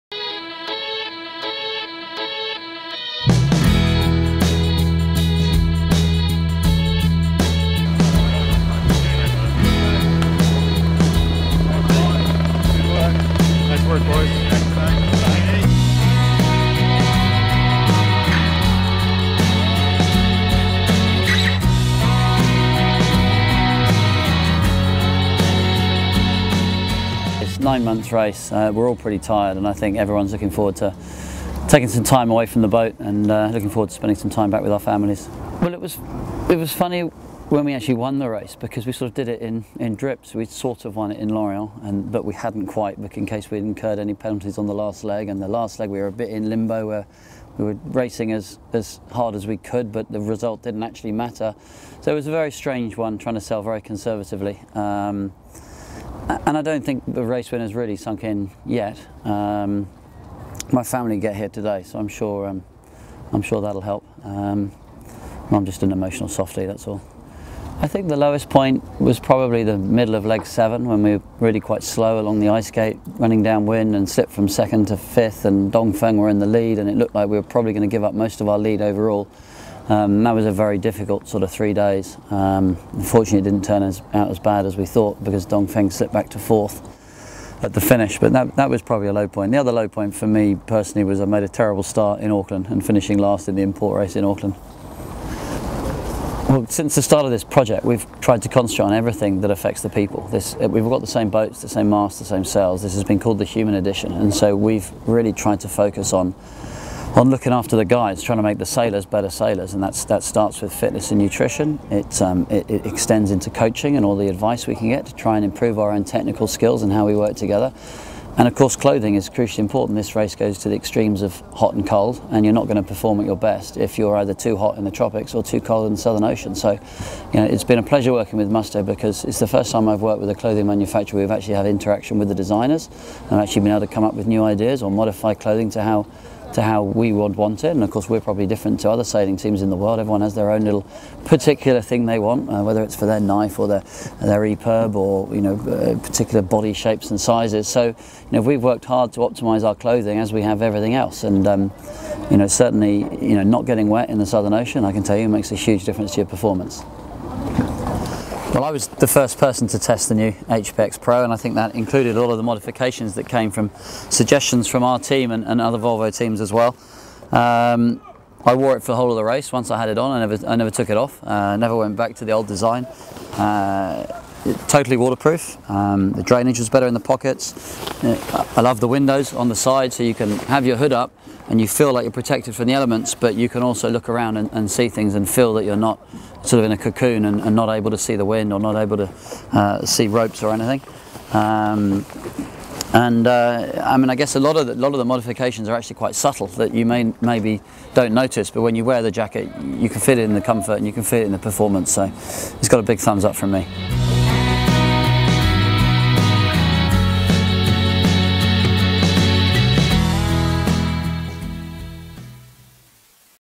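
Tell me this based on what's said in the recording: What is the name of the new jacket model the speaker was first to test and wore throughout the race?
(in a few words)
HPX Pro.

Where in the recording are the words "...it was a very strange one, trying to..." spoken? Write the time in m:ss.
0:52.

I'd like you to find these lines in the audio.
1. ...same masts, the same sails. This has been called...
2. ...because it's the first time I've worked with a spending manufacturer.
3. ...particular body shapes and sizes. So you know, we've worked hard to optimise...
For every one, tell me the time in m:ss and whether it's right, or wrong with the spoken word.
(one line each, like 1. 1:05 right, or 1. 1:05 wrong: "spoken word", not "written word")
1. 1:41 right
2. 2:08 wrong: "clothing", not "spending"
3. 2:25 right.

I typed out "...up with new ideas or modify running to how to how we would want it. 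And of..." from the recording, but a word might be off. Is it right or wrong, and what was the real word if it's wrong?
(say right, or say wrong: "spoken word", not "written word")
wrong: "clothing", not "running".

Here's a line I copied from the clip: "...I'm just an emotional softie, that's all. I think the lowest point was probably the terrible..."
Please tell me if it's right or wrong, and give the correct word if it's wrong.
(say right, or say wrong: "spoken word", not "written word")
wrong: "middle", not "terrible".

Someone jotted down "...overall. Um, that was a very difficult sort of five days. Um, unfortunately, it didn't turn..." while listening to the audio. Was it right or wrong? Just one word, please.
wrong.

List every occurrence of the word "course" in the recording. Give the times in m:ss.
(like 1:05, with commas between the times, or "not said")
1:58, 2:17.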